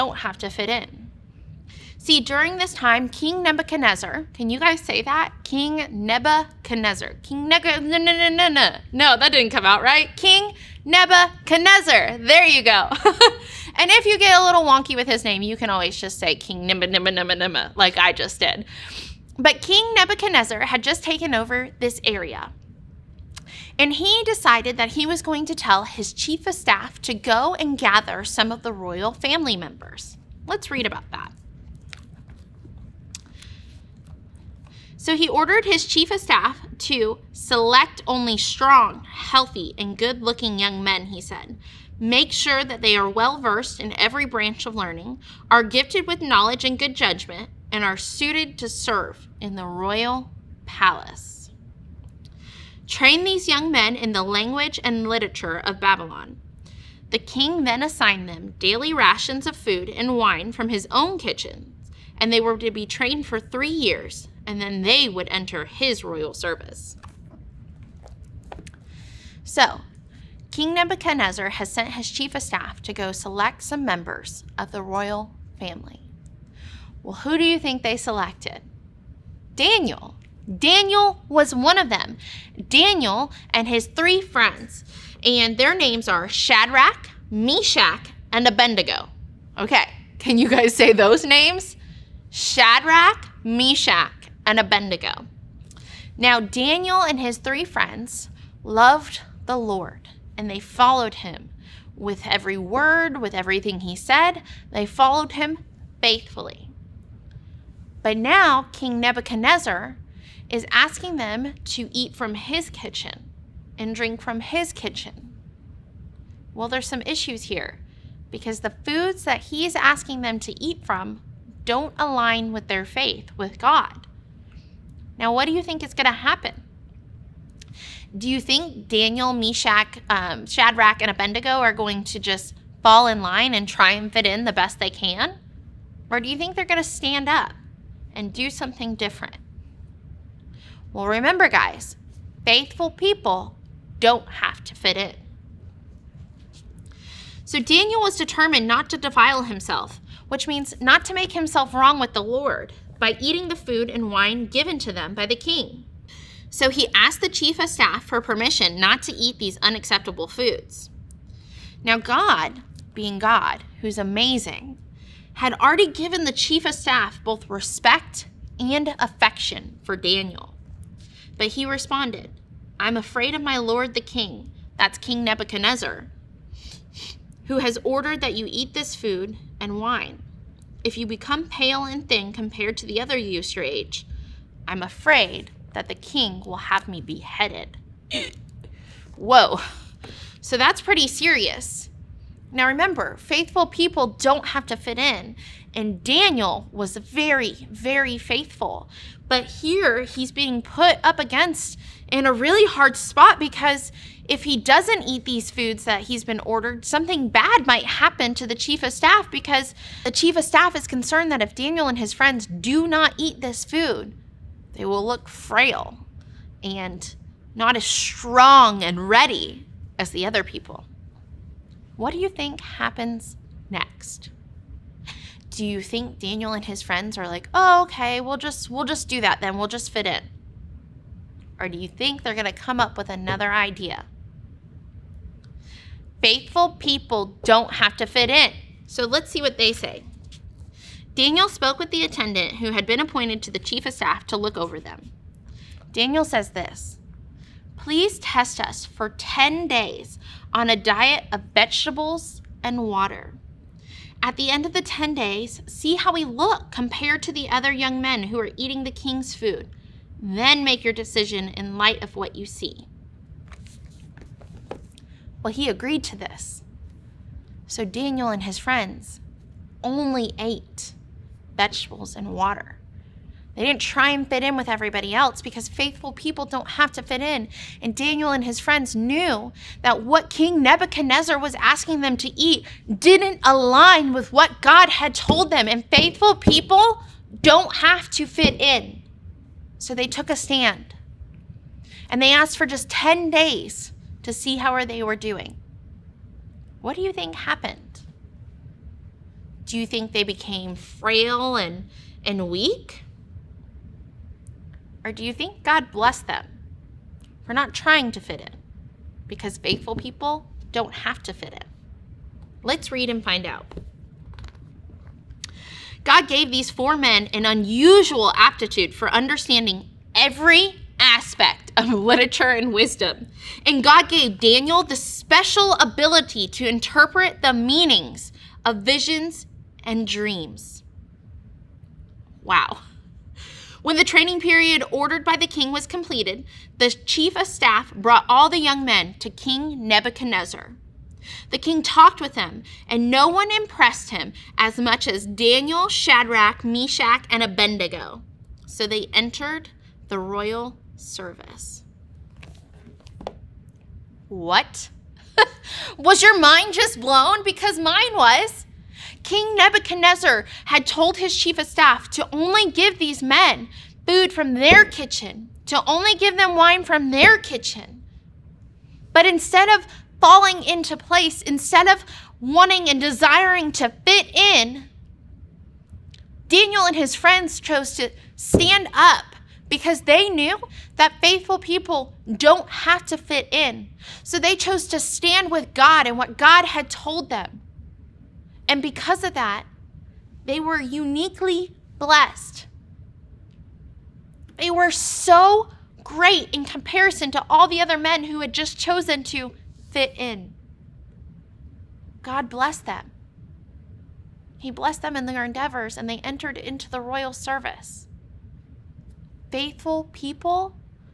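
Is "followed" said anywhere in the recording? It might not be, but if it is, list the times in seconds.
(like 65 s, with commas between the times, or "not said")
100 s, 104 s.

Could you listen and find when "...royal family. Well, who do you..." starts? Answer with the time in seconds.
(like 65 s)
74 s.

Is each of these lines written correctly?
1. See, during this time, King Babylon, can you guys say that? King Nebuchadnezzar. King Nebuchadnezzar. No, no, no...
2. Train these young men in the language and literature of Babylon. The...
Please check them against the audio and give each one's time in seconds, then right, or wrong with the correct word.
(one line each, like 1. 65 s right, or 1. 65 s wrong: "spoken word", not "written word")
1. 1 s wrong: "Nebuchadnezzar", not "Babylon"
2. 52 s right.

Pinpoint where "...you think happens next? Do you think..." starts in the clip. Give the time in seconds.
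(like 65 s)
222 s.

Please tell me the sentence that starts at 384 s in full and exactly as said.
So they chose to stand with God and what God had told them.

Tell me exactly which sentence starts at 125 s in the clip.
Now, what do you think is going to happen?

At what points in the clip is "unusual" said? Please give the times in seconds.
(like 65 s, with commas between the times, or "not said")
317 s.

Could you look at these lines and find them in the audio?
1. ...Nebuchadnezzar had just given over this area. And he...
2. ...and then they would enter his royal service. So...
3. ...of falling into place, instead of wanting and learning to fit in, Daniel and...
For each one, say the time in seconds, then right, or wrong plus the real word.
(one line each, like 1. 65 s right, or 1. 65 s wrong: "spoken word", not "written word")
1. 19 s wrong: "taken", not "given"
2. 64 s right
3. 369 s wrong: "desiring", not "learning".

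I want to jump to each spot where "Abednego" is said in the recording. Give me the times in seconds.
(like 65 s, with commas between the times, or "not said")
88 s, 94 s, 131 s, 347 s.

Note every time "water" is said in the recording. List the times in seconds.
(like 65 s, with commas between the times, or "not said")
252 s, 272 s.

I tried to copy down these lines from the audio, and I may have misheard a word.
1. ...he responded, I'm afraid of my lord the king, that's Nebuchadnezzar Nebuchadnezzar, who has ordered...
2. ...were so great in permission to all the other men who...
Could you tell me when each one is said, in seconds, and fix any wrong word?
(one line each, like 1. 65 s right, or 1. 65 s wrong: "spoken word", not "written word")
1. 171 s wrong: "King", not "Nebuchadnezzar"
2. 394 s wrong: "comparison", not "permission".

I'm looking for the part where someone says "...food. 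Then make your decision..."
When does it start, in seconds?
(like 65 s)
259 s.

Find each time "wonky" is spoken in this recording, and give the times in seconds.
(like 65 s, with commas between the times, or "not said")
14 s.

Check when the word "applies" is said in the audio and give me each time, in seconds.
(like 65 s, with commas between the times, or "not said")
not said.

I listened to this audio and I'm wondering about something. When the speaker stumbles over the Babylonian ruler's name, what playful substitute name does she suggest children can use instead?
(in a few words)
King Nimba Nimba Nimba Nimba.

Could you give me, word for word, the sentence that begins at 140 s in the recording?
Well, remember, guys, faithful people don't have to fit in.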